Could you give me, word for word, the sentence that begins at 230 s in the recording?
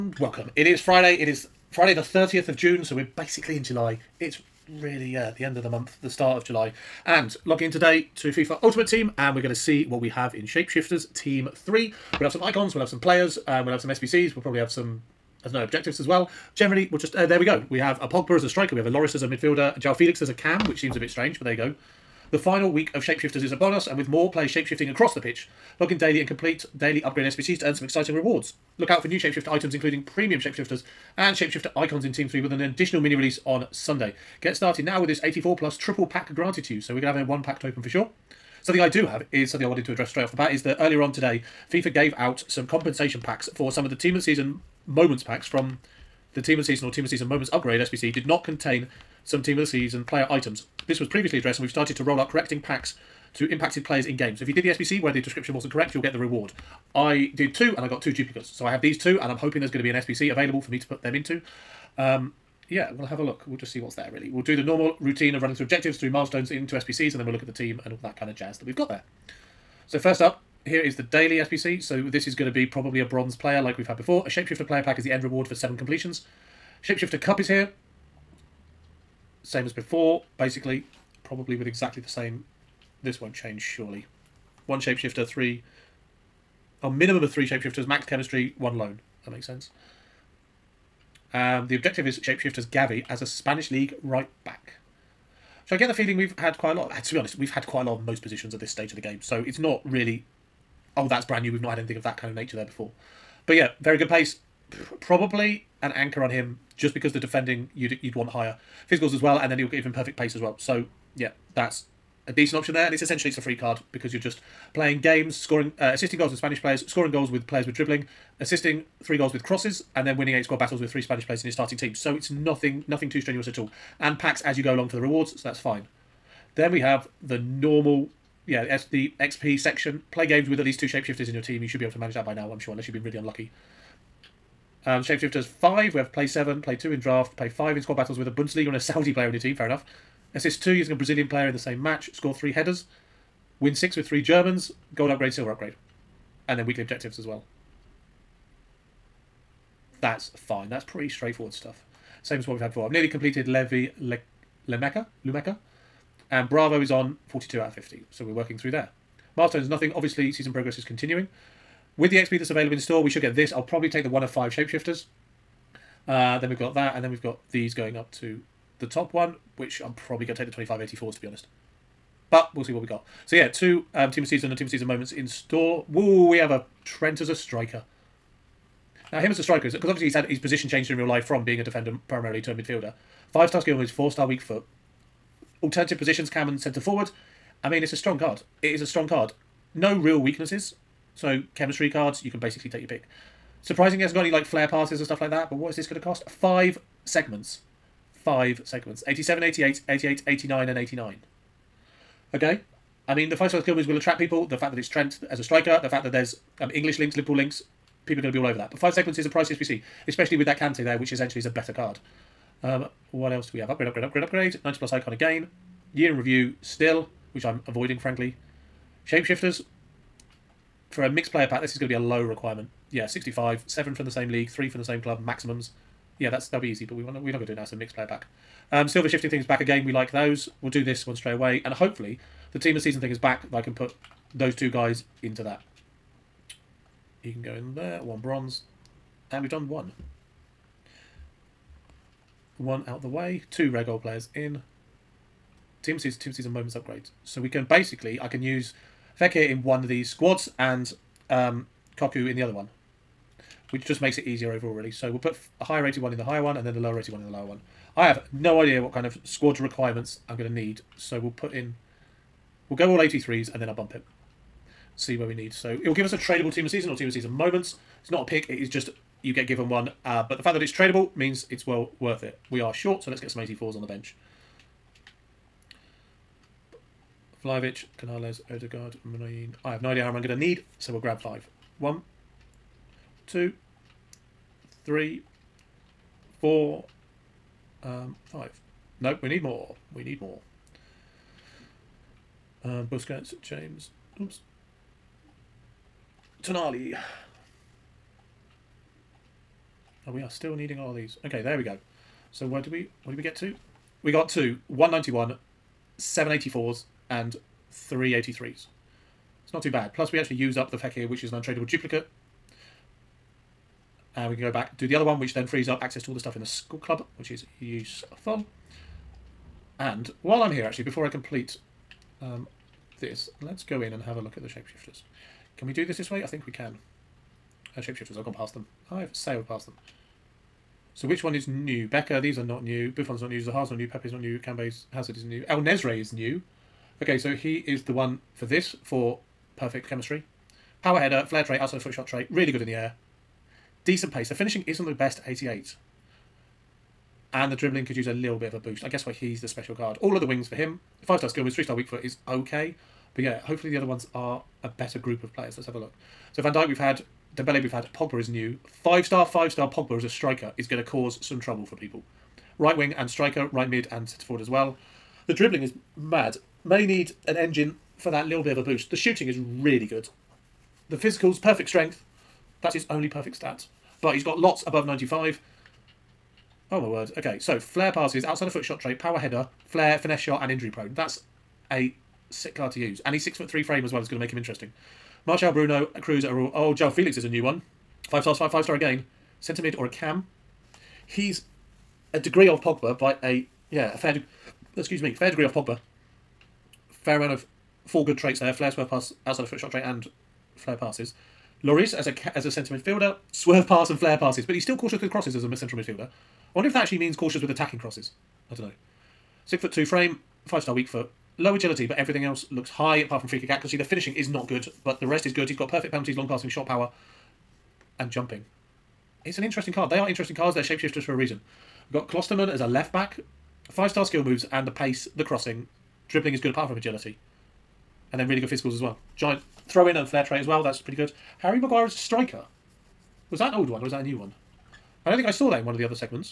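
We'll do this one straight away, and hopefully, the team of season thing is back.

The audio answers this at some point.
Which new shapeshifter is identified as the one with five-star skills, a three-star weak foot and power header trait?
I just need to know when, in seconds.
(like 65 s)
335 s.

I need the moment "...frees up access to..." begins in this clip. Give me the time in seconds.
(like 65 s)
315 s.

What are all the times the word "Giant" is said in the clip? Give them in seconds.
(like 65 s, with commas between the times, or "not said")
429 s.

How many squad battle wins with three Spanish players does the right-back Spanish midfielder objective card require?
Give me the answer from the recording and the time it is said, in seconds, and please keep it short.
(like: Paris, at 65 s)
8, at 120 s.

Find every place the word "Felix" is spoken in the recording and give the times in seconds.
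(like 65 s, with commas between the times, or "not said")
19 s, 386 s.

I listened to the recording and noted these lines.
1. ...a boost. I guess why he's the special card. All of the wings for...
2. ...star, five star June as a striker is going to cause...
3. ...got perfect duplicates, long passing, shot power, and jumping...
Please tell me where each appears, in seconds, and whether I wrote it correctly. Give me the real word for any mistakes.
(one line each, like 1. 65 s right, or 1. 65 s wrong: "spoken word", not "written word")
1. 348 s right
2. 359 s wrong: "Pogba", not "June"
3. 415 s wrong: "penalties", not "duplicates".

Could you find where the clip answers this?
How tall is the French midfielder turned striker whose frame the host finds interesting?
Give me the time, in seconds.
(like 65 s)
383 s.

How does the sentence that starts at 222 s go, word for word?
Yeah, 65, 7 from the same league, 3 from the same club, maximums.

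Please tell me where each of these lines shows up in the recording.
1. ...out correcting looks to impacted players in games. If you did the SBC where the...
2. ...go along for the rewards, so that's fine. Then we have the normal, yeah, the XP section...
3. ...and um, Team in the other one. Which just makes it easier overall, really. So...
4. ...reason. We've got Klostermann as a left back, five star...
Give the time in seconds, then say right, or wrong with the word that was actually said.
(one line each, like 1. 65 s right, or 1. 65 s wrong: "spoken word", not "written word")
1. 52 s wrong: "packs", not "looks"
2. 124 s right
3. 250 s wrong: "Kaku", not "Team"
4. 421 s right.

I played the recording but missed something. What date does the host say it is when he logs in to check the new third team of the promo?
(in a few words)
Friday the 30th of June.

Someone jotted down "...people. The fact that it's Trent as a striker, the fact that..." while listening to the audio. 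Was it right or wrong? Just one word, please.
right.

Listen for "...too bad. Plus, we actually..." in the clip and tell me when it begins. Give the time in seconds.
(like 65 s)
309 s.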